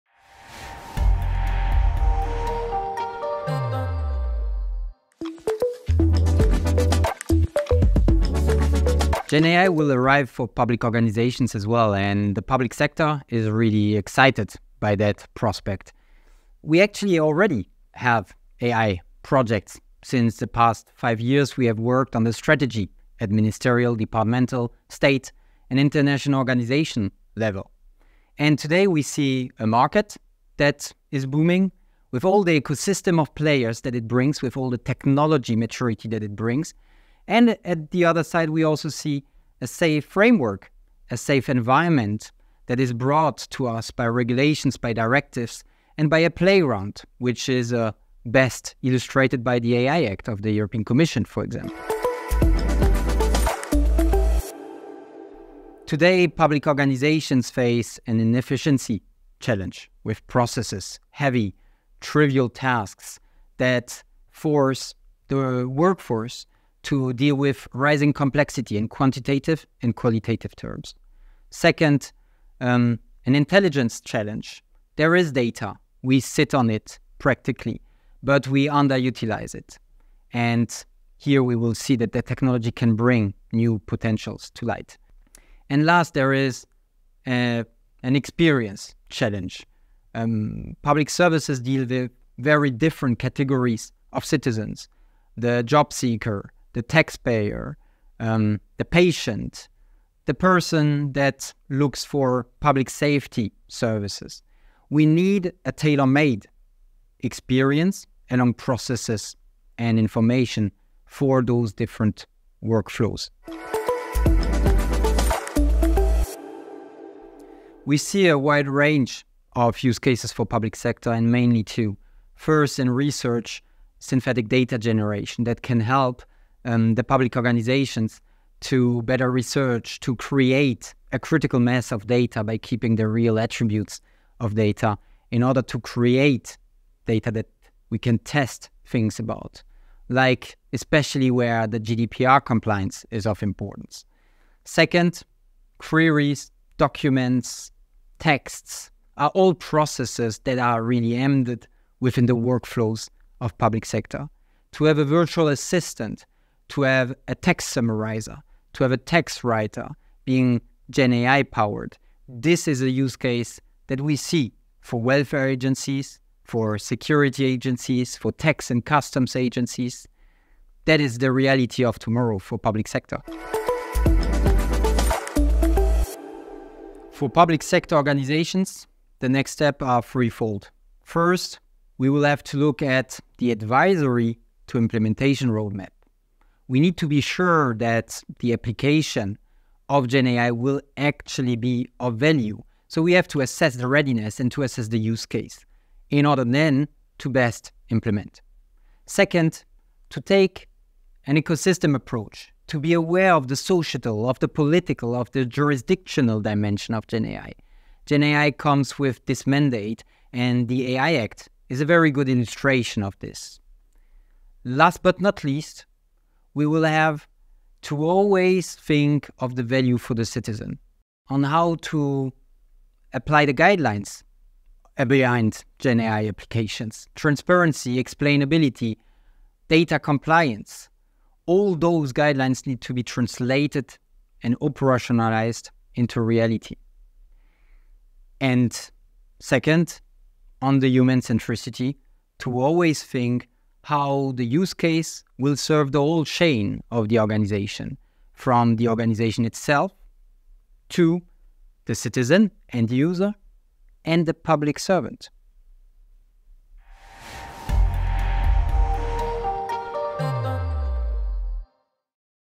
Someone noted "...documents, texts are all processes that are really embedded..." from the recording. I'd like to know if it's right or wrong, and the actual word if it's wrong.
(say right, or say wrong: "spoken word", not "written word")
right.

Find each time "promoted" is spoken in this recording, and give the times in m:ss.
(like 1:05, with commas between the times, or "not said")
not said.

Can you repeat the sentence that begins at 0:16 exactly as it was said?
We actually already have AI projects.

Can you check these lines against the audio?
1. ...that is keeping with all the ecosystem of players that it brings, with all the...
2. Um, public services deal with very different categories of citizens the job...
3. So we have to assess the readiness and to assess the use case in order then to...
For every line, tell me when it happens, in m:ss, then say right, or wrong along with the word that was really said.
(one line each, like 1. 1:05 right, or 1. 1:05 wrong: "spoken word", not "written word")
1. 0:30 wrong: "booming", not "keeping"
2. 1:30 right
3. 3:12 right.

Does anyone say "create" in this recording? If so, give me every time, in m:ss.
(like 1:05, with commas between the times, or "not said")
2:10, 2:15.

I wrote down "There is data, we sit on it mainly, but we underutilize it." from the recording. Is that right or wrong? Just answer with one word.
wrong.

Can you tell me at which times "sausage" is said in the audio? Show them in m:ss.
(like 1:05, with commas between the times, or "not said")
not said.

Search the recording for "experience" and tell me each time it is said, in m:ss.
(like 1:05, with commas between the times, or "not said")
1:28, 1:47.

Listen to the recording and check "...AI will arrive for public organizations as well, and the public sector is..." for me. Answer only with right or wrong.
right.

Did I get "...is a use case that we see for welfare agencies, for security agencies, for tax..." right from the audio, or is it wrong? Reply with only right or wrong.
right.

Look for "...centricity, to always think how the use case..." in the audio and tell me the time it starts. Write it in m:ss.
4:01.